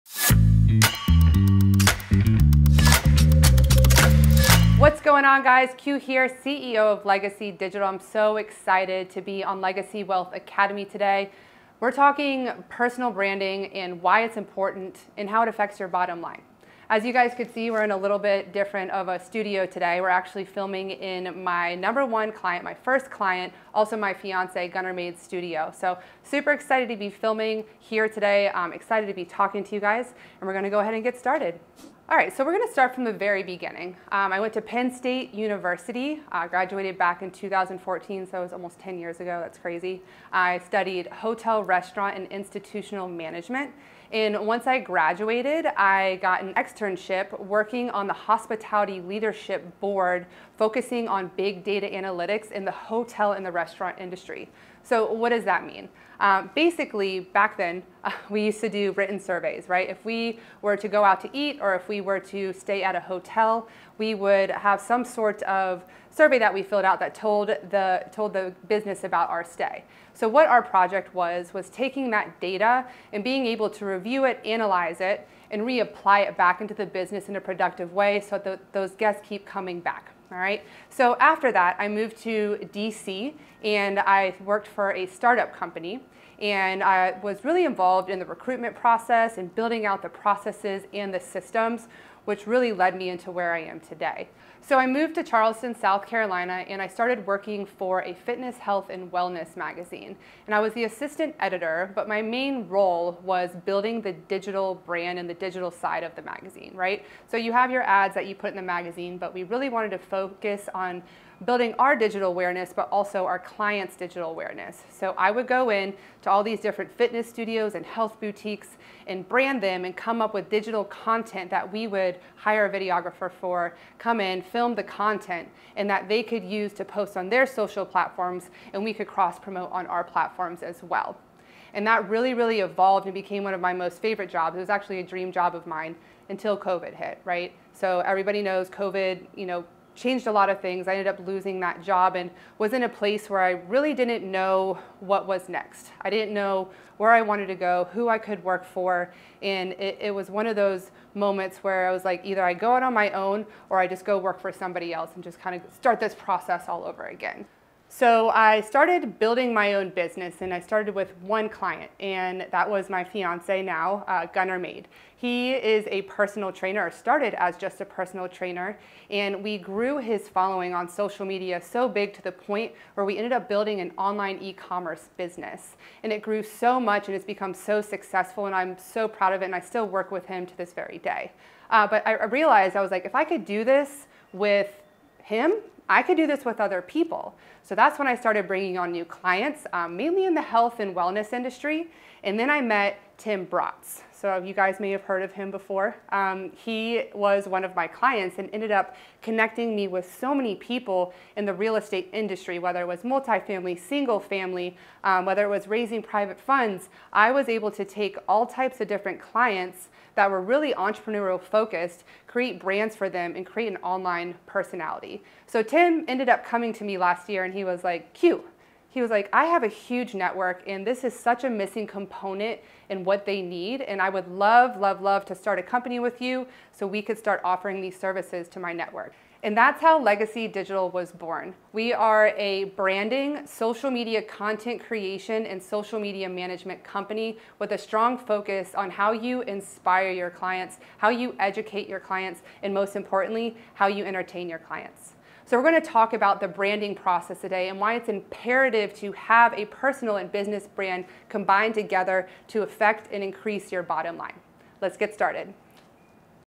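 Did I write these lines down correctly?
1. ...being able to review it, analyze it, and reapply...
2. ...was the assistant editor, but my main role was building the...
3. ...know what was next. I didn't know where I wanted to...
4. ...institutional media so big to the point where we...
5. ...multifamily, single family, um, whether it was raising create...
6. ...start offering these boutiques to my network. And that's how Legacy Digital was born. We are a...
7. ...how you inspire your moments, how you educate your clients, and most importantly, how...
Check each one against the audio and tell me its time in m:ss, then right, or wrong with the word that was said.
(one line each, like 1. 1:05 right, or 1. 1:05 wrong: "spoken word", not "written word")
1. 1:13 right
2. 1:40 right
3. 2:24 right
4. 2:50 wrong: "social", not "institutional"
5. 3:23 wrong: "private", not "create"
6. 3:47 wrong: "services", not "boutiques"
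7. 3:58 wrong: "clients", not "moments".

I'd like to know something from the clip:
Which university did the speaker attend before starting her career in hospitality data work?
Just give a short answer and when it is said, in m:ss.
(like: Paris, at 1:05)
Penn State University, at 0:34.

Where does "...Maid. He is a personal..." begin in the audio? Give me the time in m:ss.
2:44.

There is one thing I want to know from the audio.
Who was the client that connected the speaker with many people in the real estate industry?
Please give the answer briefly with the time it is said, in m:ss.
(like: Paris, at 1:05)
Tim Bratz, at 3:13.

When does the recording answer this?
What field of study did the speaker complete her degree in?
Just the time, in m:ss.
0:41.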